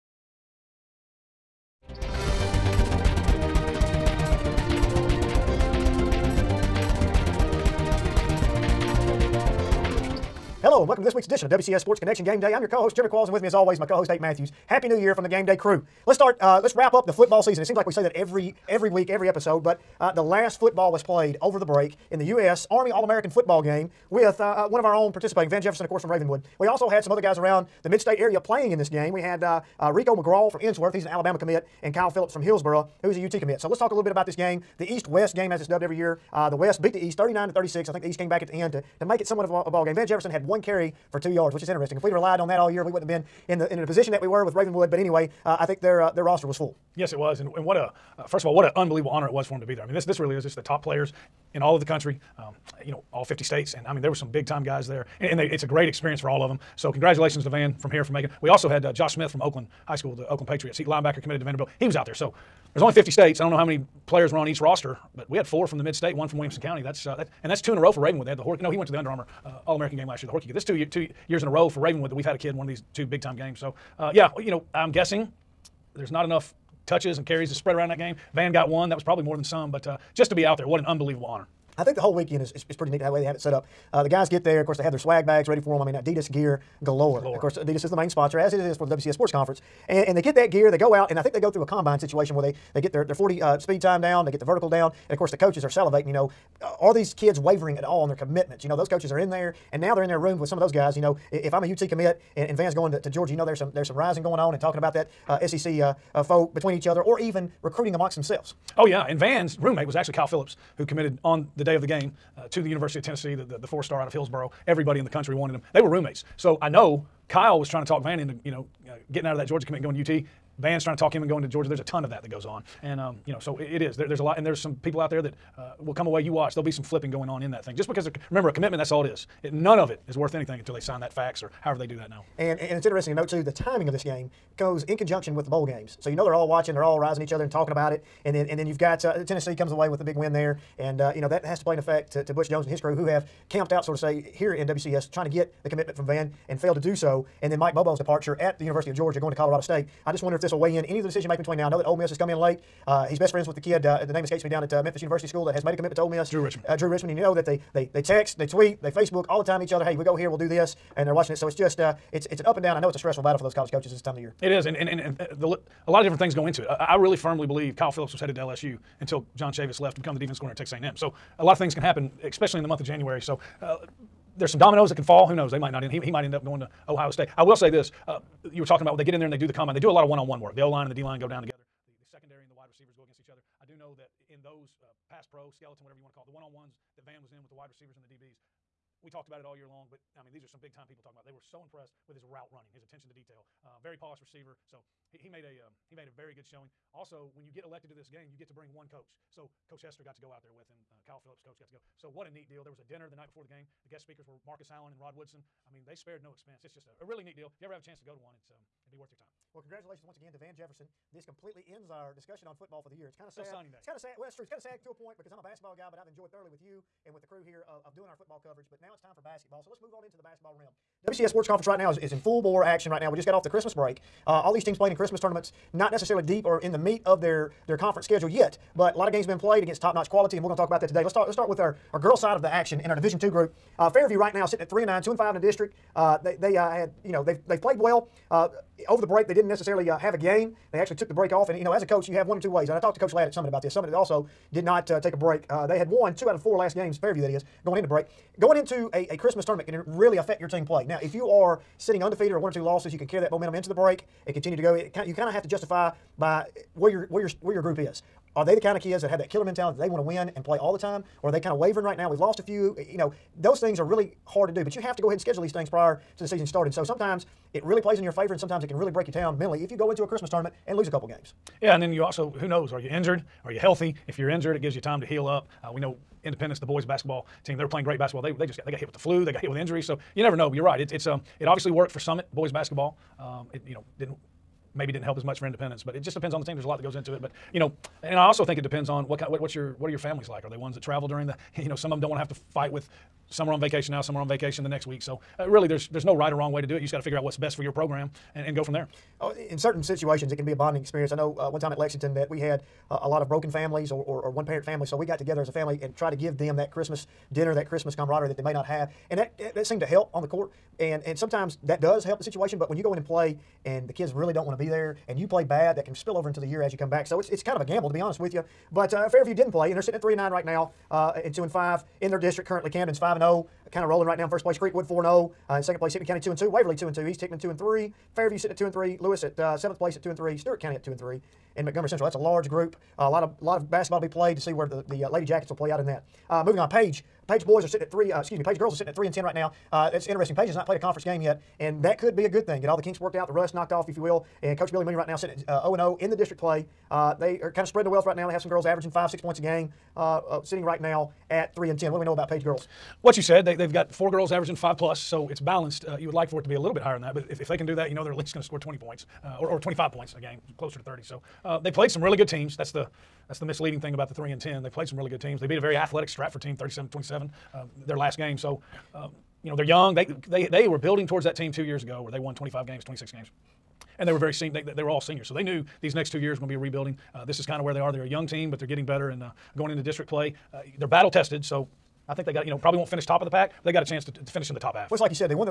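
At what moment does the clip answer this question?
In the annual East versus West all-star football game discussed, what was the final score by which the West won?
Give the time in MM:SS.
00:37.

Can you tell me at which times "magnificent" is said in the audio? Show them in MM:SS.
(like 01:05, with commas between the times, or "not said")
not said.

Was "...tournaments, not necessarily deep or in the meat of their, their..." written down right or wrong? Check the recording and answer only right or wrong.
right.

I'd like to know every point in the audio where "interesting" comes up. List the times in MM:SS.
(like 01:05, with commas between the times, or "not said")
00:41, 02:12, 05:40.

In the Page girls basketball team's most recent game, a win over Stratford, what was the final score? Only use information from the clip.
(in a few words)
37-27.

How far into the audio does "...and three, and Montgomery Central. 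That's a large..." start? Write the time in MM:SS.
05:30.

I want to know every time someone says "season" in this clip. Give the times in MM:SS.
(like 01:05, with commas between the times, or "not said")
00:17, 04:26.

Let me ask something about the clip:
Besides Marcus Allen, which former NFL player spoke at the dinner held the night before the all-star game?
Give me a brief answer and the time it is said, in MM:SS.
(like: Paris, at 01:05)
Rod Woodson, at 03:24.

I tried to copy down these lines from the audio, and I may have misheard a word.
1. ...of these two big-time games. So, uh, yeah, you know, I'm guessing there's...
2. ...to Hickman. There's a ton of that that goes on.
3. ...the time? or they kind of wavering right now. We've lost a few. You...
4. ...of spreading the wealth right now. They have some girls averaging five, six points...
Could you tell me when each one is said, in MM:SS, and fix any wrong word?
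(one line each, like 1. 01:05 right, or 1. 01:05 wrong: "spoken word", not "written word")
1. 01:12 right
2. 02:01 wrong: "Georgia", not "Hickman"
3. 04:20 right
4. 05:47 right.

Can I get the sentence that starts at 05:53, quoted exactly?
What you said, they, they've got four girls averaging five plus, so it's balanced.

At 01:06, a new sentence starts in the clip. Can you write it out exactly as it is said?
That's uh, that, and that's two in a row for Ravenwood.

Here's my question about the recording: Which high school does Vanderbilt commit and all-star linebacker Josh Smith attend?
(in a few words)
Oakland High School.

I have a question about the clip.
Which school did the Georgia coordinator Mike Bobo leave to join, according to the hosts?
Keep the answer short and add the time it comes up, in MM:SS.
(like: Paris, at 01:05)
Colorado State, at 02:29.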